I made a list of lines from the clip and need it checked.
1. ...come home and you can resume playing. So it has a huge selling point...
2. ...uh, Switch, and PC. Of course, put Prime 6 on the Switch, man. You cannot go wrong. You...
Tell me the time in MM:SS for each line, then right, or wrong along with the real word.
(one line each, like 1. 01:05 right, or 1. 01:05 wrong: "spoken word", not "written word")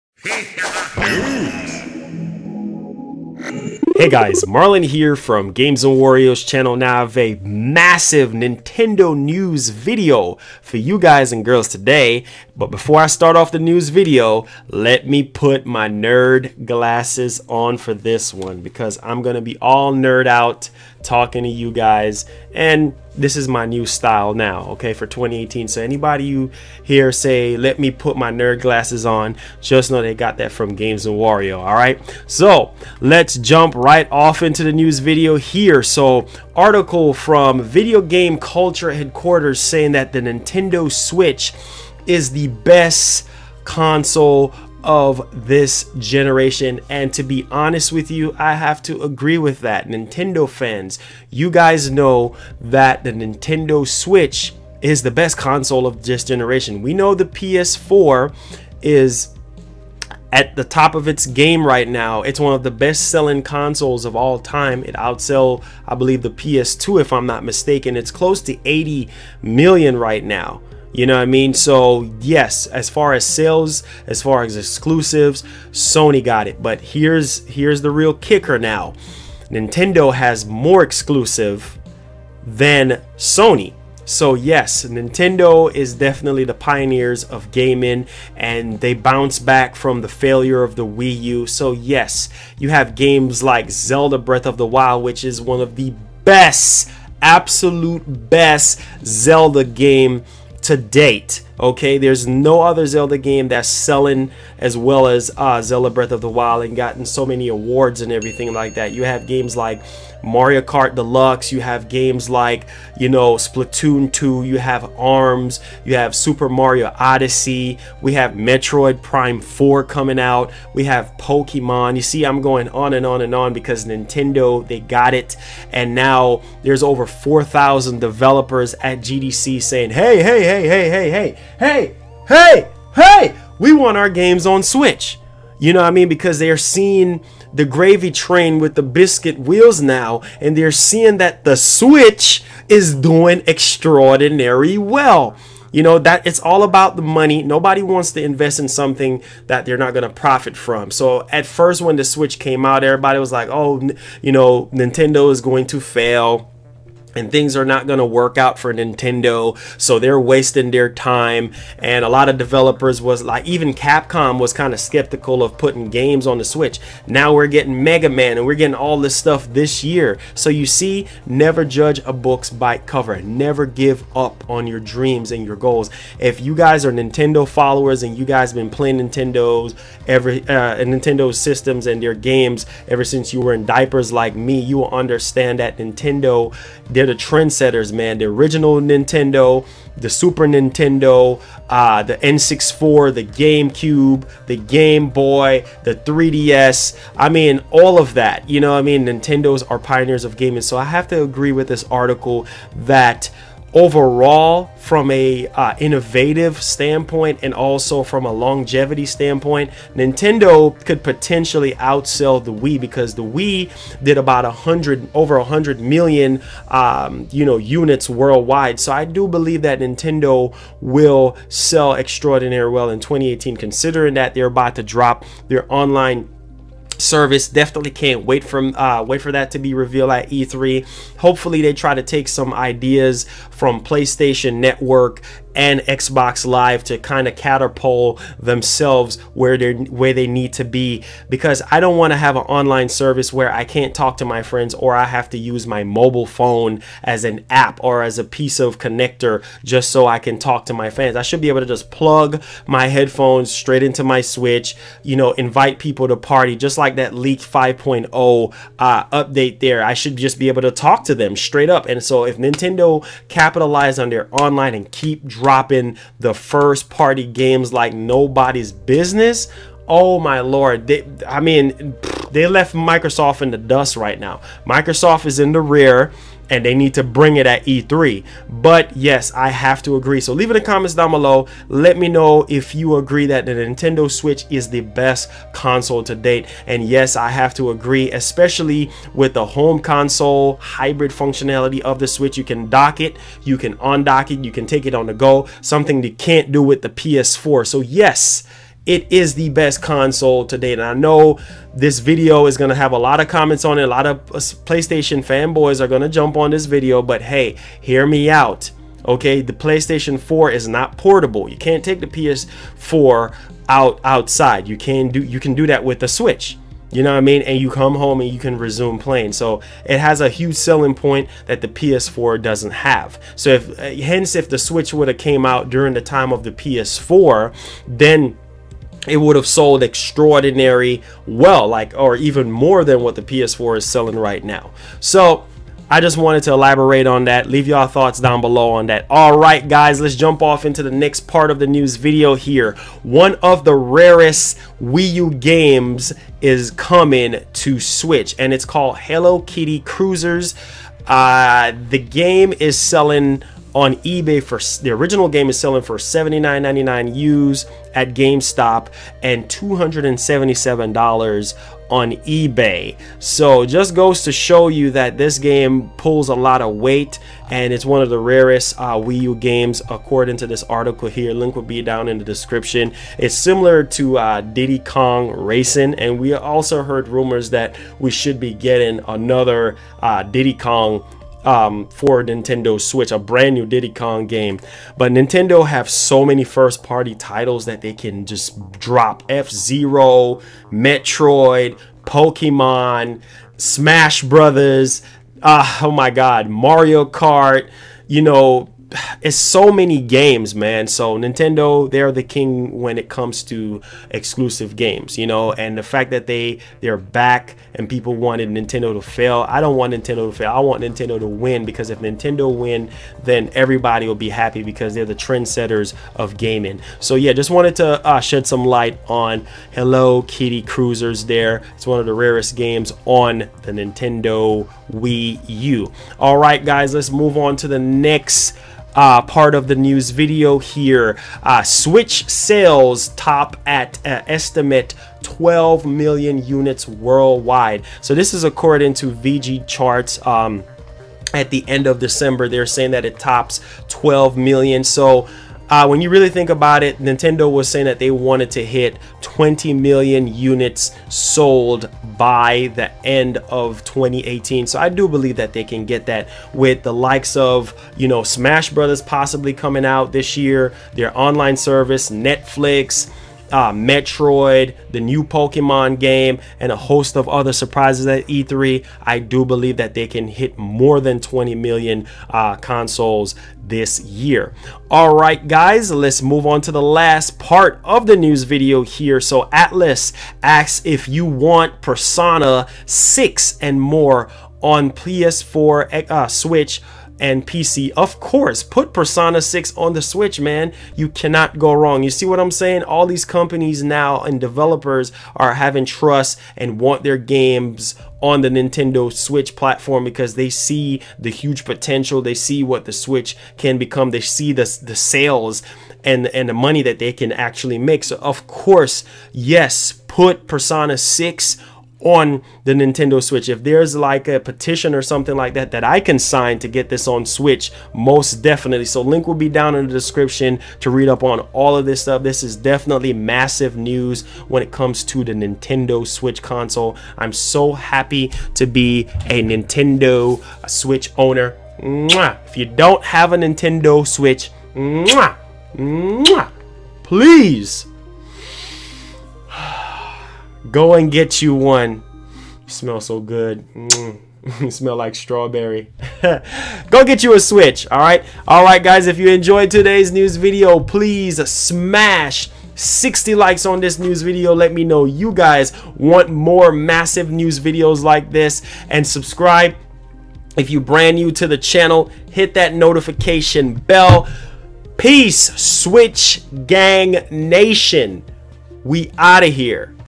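1. 05:17 right
2. 08:06 wrong: "Persona", not "Prime".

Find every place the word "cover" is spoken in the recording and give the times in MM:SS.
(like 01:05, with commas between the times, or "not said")
02:52.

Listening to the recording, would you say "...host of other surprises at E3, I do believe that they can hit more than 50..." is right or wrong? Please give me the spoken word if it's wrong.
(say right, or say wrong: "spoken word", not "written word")
wrong: "20", not "50".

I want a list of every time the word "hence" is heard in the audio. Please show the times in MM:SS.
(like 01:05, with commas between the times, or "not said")
05:24.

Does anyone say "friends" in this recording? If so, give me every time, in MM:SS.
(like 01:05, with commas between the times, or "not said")
04:04.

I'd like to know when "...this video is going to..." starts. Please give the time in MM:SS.
05:01.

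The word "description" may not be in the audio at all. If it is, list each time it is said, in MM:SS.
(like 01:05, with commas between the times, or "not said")
06:12, 08:39.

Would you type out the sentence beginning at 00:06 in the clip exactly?
Now I have a massive Nintendo news video for you guys and girls today.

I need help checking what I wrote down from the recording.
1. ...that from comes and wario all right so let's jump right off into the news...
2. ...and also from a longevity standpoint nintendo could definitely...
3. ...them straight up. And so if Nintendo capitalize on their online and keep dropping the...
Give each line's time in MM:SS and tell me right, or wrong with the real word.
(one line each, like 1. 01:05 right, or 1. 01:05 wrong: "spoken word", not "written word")
1. 00:30 wrong: "games", not "comes"
2. 03:27 wrong: "potentially", not "definitely"
3. 04:21 right.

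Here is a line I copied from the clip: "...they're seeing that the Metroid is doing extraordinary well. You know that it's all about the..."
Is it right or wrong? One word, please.
wrong.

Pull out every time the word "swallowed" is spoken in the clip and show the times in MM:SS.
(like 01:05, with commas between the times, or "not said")
not said.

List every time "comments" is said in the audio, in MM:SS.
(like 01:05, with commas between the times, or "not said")
04:40, 05:03.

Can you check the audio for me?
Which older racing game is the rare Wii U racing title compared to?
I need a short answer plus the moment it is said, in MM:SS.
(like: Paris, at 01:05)
Diddy Kong Racing, at 06:14.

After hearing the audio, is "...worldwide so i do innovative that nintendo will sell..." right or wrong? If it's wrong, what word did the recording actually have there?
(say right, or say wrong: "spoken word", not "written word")
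wrong: "believe", not "innovative".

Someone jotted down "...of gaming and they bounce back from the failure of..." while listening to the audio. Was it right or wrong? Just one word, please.
right.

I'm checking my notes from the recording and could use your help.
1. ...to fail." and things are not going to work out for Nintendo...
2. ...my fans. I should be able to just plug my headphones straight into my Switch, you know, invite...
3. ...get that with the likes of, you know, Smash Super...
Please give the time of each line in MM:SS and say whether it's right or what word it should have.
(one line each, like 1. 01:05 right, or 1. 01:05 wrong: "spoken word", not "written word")
1. 02:35 right
2. 04:10 right
3. 07:35 wrong: "Brothers", not "Super".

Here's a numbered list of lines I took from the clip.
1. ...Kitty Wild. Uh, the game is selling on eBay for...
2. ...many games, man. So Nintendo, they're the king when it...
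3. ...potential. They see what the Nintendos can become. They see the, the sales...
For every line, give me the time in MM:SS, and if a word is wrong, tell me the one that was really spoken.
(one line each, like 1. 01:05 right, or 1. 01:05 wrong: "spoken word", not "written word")
1. 05:49 wrong: "Kruisers", not "Wild"
2. 06:39 right
3. 08:21 wrong: "Switch", not "Nintendos".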